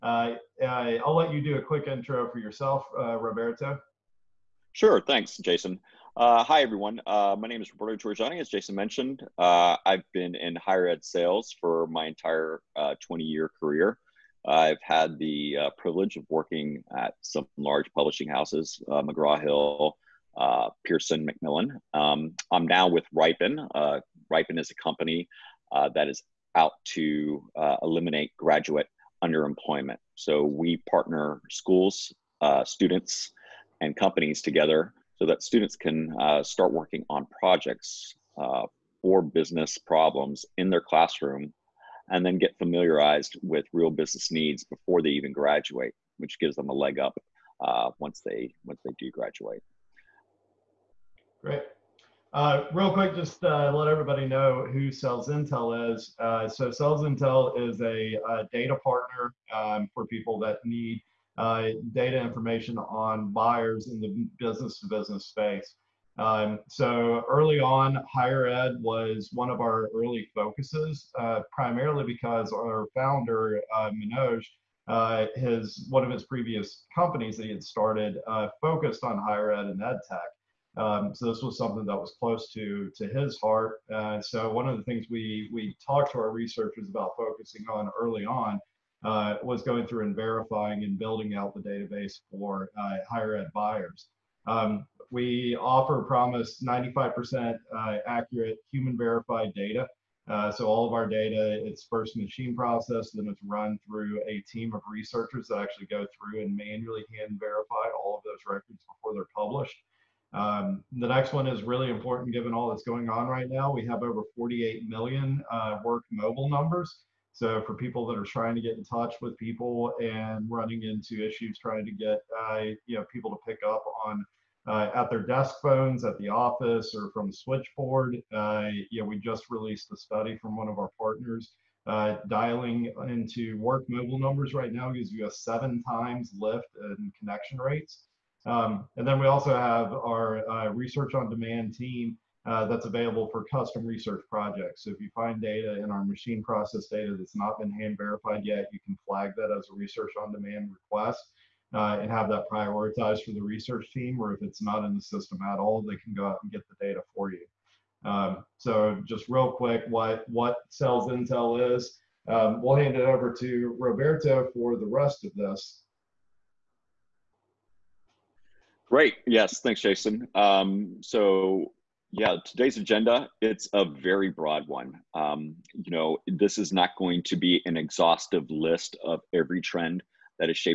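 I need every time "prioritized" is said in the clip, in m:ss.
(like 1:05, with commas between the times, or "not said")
2:32.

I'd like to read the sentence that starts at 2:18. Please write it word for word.
Um, and then we also have our uh, research on demand team uh, that's available for custom research projects.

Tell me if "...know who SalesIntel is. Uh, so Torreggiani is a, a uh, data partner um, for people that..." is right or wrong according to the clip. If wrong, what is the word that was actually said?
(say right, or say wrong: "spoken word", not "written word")
wrong: "SalesIntel", not "Torreggiani".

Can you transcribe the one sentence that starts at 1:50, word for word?
Um, the next one is really important given all that's going on right now.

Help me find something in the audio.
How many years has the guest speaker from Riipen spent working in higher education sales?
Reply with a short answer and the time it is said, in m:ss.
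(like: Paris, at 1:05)
20, at 0:13.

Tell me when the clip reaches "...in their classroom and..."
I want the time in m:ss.
0:40.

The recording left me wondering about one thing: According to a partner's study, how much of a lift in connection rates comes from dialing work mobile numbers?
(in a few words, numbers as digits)
7 times.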